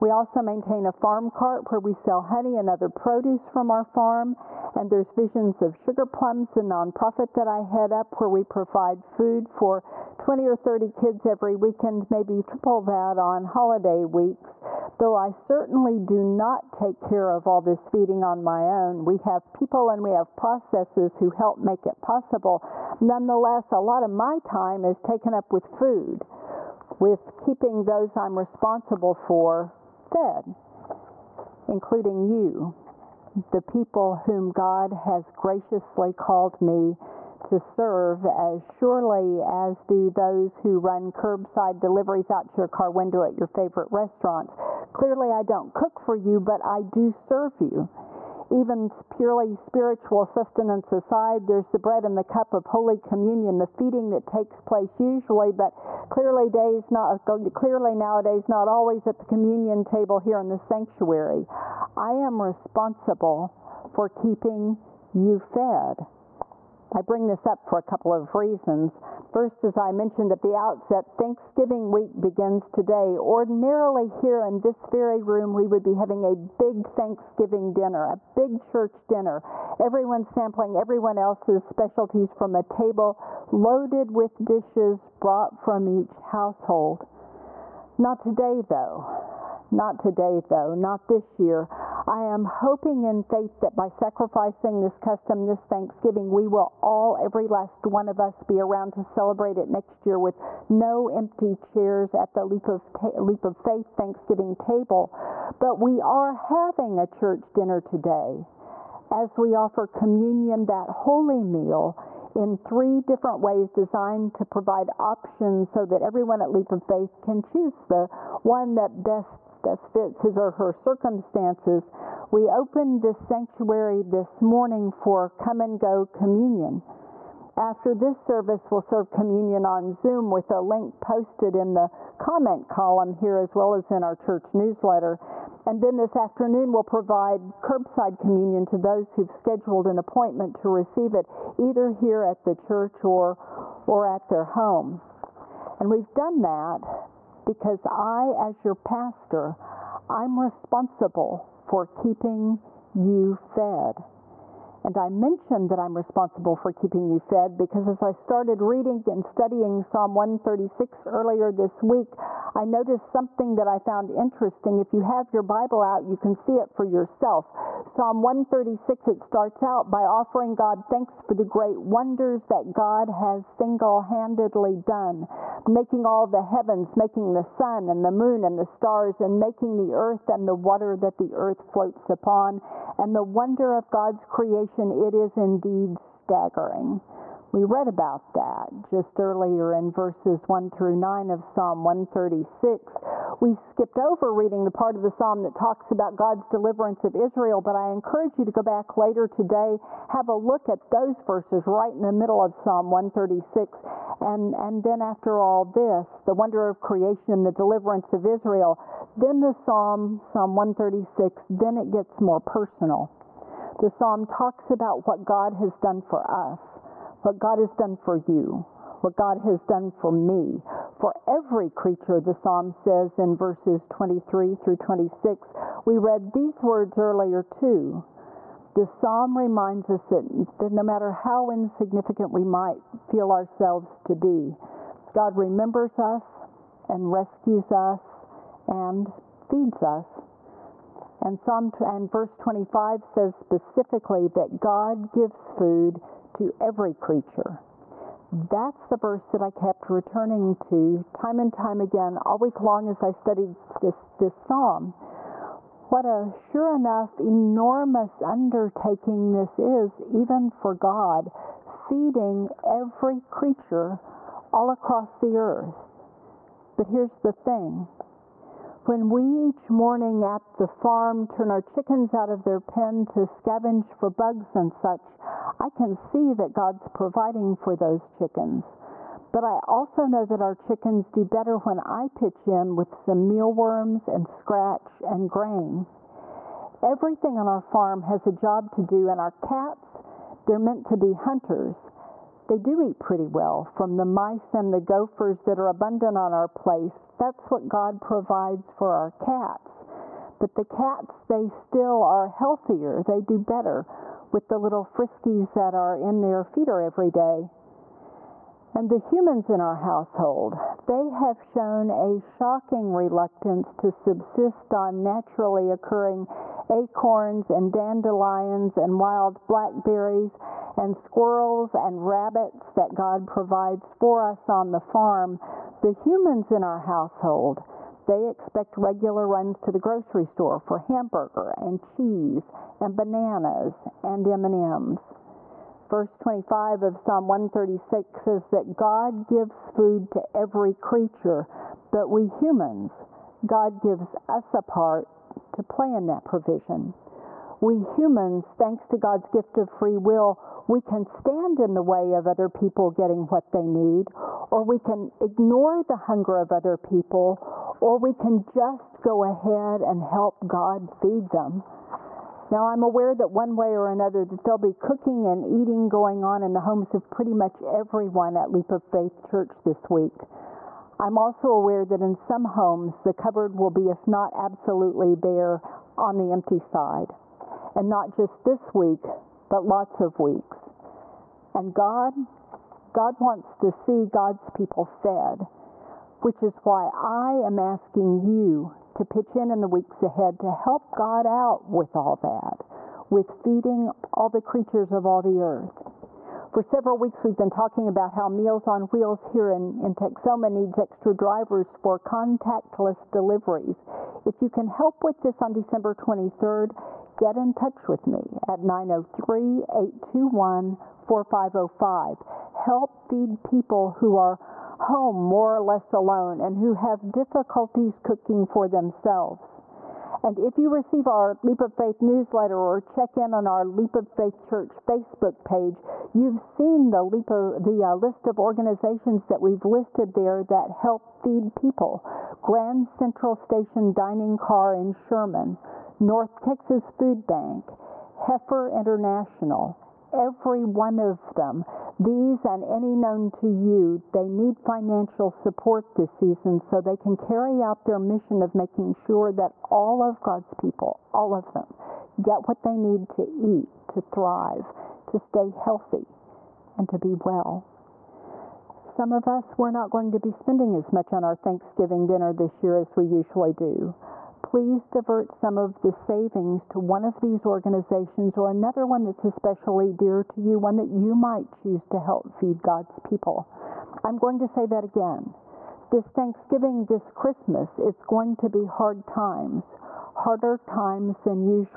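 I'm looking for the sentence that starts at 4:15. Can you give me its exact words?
What a sure enough enormous undertaking this is, even for God, feeding every creature all across the earth.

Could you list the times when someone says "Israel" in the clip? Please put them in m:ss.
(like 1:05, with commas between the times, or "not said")
3:17, 3:28.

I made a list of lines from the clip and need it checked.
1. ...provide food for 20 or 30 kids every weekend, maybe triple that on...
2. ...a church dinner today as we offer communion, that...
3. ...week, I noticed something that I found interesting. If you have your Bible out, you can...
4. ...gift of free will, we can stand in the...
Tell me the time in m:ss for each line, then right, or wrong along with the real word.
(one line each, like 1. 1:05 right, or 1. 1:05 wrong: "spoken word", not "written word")
1. 0:08 right
2. 1:46 right
3. 2:41 right
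4. 5:49 right.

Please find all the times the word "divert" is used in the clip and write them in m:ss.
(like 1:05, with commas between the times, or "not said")
7:44.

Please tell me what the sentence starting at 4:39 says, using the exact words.
But I also know that our chickens do better when I pitch in with some mealworms and scratch and grain.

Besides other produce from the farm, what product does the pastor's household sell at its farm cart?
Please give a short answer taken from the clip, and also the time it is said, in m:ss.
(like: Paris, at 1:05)
honey, at 0:02.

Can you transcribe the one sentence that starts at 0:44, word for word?
Clearly, I don't cook for you, but I do serve you.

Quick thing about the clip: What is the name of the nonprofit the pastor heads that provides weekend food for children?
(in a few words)
Visions of Sugar Plums.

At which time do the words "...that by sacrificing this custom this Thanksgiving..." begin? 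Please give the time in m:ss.
1:33.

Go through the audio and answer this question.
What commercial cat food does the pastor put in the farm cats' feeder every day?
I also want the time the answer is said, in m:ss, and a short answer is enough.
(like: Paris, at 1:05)
Friskies, at 5:04.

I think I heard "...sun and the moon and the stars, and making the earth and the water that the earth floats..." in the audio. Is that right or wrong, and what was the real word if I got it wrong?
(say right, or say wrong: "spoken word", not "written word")
right.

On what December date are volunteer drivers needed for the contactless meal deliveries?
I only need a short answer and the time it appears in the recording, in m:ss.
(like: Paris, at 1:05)
December 23, at 6:45.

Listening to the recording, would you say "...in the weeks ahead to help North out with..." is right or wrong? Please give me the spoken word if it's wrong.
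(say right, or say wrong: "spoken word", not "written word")
wrong: "God", not "North".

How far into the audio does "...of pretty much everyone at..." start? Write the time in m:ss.
6:06.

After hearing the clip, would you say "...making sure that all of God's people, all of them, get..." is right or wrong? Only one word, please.
right.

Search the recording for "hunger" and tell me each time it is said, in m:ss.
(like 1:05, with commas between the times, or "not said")
5:56.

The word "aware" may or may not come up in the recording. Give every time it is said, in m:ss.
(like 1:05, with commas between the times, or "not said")
6:02, 6:11.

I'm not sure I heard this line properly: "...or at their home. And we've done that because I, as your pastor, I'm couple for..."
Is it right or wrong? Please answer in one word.
wrong.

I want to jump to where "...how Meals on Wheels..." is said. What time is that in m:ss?
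6:38.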